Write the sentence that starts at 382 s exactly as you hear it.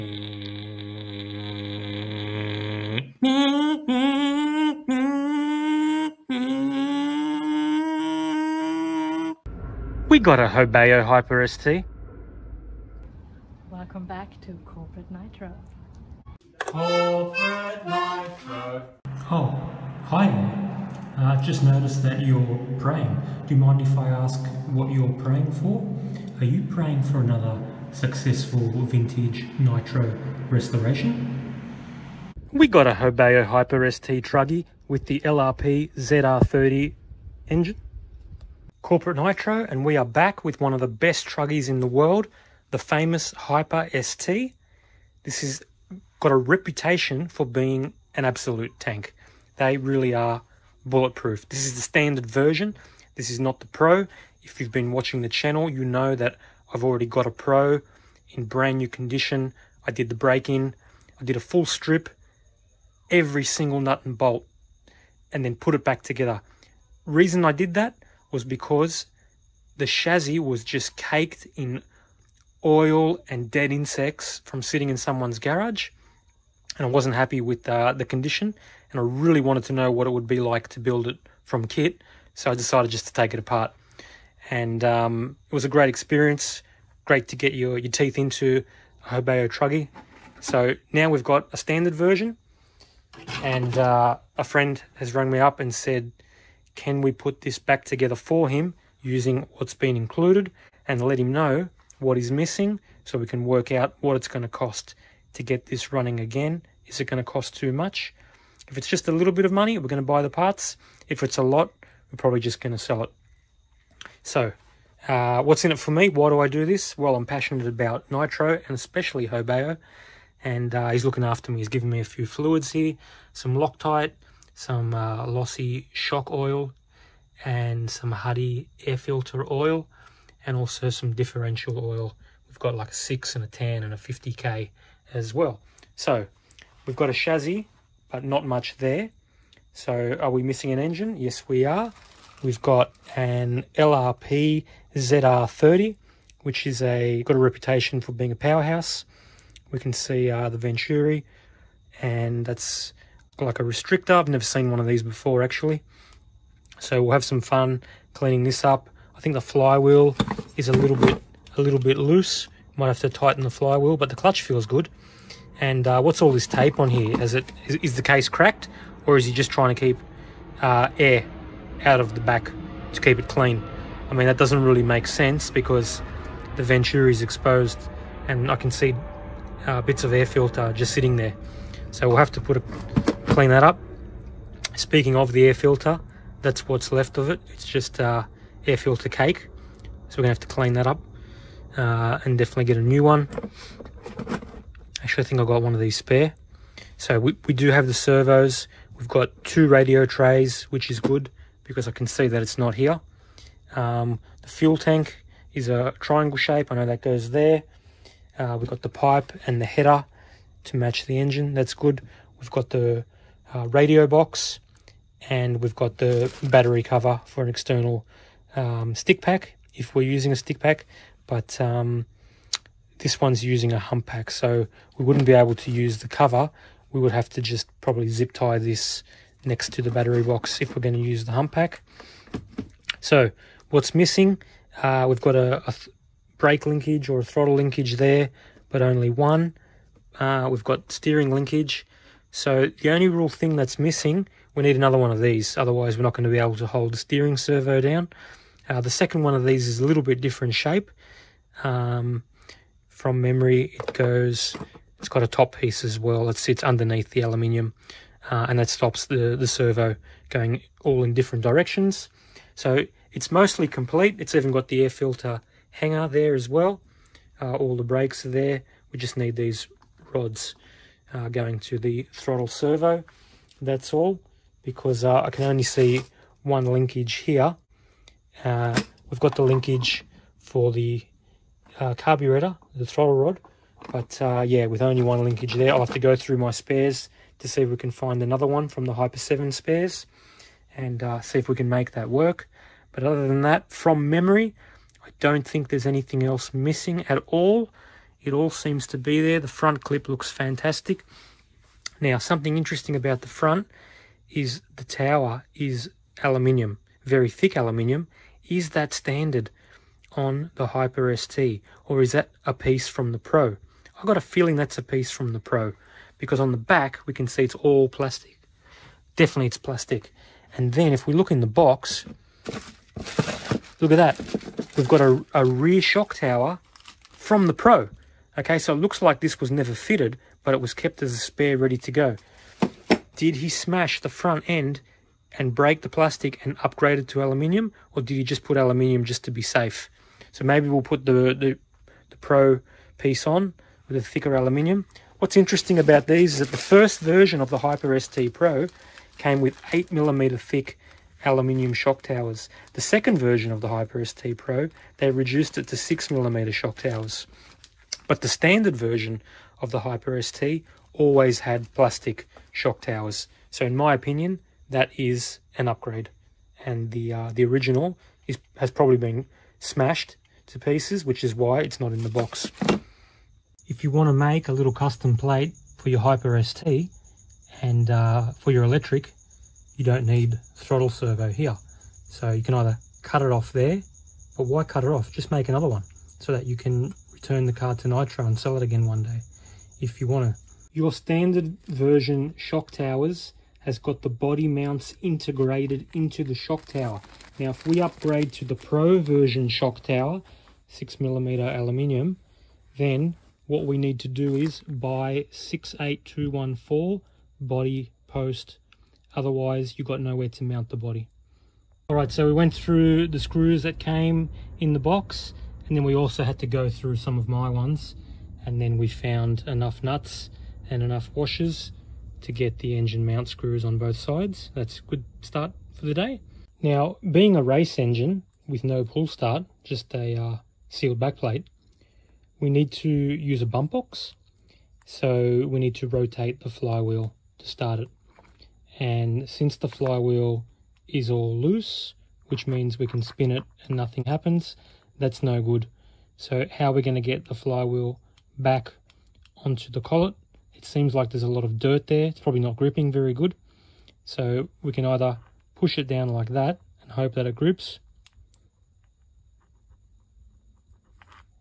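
So you can either cut it off there, but why cut it off?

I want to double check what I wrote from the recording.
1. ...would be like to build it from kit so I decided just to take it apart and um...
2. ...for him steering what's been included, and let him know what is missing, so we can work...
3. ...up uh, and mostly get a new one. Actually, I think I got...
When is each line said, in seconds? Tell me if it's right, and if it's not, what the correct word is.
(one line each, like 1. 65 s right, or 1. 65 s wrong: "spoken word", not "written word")
1. 80 s right
2. 98 s wrong: "using", not "steering"
3. 190 s wrong: "definitely", not "mostly".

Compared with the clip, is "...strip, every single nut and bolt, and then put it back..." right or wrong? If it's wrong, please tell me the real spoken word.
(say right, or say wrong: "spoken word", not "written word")
right.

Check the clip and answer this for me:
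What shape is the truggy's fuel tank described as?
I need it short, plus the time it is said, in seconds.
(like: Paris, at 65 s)
Triangle, at 205 s.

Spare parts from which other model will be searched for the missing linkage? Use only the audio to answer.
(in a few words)
Hyper 7.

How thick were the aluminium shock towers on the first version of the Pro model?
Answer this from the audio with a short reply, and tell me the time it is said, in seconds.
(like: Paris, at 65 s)
8mm, at 349 s.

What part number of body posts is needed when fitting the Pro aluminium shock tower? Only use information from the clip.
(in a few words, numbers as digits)
68214.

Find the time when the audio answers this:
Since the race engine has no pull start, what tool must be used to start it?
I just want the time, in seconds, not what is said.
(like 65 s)
433 s.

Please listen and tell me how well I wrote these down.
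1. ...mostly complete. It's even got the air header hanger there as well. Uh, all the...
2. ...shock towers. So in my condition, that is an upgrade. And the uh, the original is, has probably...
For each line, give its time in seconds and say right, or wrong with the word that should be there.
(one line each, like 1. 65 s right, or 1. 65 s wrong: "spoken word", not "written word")
1. 263 s wrong: "filter", not "header"
2. 362 s wrong: "opinion", not "condition".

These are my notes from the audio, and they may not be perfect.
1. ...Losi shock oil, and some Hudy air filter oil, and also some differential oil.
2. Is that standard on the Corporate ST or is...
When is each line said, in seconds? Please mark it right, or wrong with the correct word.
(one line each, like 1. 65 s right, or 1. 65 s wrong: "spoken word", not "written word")
1. 125 s right
2. 308 s wrong: "Hyper", not "Corporate".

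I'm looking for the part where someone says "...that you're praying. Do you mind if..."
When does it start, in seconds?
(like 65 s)
22 s.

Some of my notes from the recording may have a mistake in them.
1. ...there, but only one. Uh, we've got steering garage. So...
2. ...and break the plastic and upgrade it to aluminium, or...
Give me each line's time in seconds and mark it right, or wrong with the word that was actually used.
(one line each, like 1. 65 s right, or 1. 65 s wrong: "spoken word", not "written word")
1. 237 s wrong: "linkage", not "garage"
2. 335 s right.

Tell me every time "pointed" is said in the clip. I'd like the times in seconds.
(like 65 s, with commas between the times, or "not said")
not said.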